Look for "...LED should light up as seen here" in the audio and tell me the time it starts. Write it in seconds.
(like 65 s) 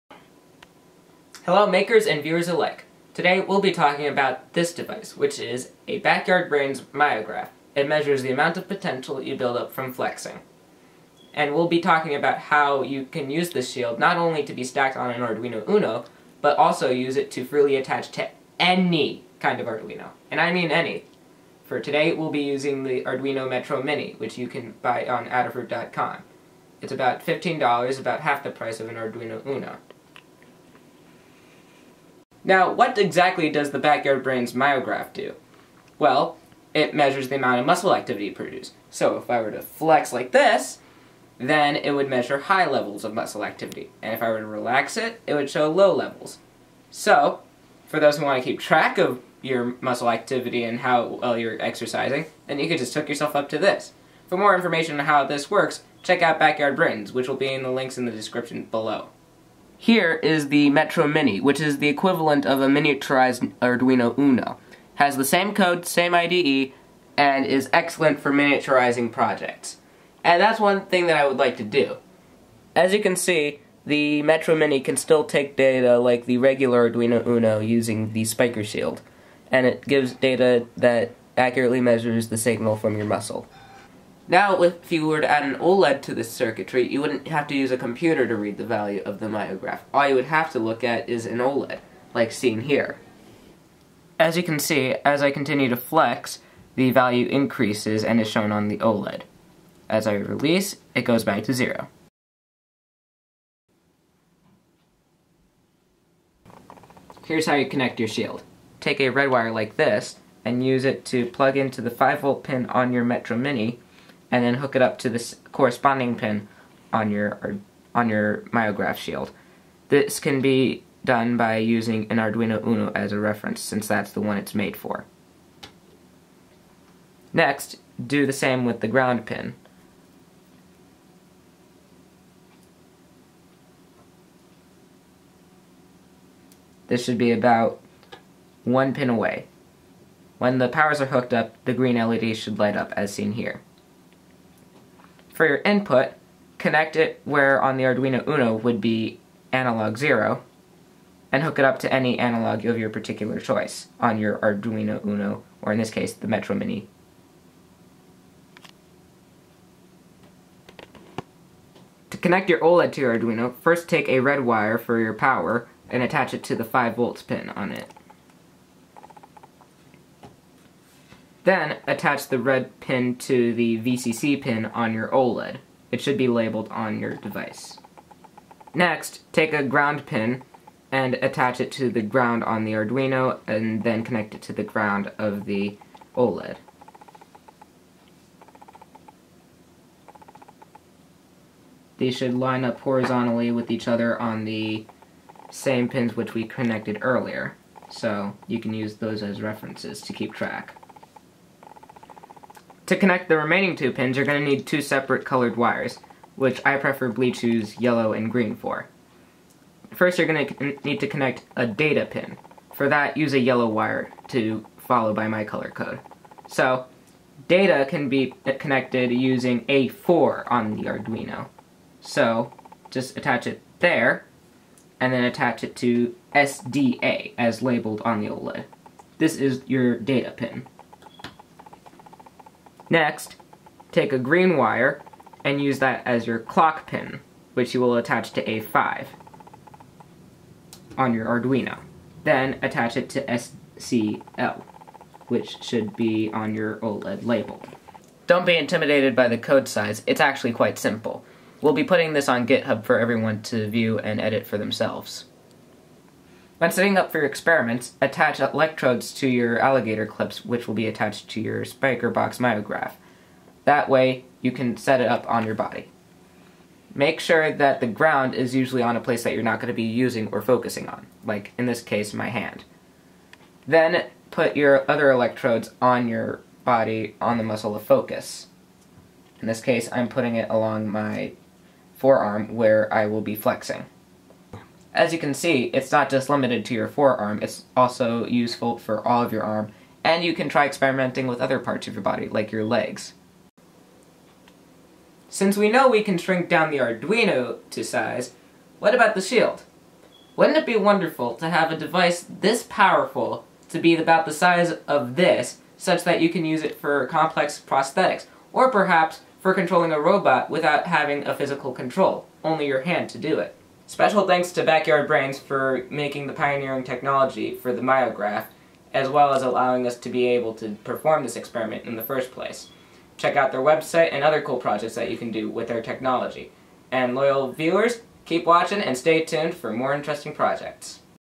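141 s.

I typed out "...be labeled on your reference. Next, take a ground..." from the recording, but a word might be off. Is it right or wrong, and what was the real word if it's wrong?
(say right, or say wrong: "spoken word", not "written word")
wrong: "device", not "reference".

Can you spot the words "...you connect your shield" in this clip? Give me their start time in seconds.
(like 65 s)
107 s.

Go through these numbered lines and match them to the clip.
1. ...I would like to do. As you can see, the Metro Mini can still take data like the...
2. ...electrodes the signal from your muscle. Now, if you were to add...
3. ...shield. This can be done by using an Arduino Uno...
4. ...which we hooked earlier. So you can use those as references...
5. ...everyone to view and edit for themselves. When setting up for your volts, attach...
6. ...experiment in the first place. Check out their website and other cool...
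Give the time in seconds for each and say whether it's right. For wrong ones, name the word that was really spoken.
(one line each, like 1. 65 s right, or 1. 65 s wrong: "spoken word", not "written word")
1. 71 s right
2. 81 s wrong: "measures", not "electrodes"
3. 118 s right
4. 196 s wrong: "connected", not "hooked"
5. 252 s wrong: "experiments", not "volts"
6. 321 s right.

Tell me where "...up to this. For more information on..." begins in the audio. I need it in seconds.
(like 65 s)
53 s.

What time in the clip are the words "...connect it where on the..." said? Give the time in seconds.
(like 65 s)
146 s.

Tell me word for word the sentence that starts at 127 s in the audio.
Next, do the same with the ground pin.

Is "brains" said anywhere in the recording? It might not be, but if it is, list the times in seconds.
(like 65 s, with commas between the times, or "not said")
6 s, 34 s, 56 s, 315 s.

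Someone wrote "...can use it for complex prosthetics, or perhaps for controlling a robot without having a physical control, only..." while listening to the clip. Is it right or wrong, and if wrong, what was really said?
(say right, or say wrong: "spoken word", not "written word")
right.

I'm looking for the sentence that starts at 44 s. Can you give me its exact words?
And if I were to relax it, it would show low levels.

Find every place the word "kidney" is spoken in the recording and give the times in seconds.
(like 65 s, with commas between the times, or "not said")
not said.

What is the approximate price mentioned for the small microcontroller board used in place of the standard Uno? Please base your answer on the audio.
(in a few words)
$15.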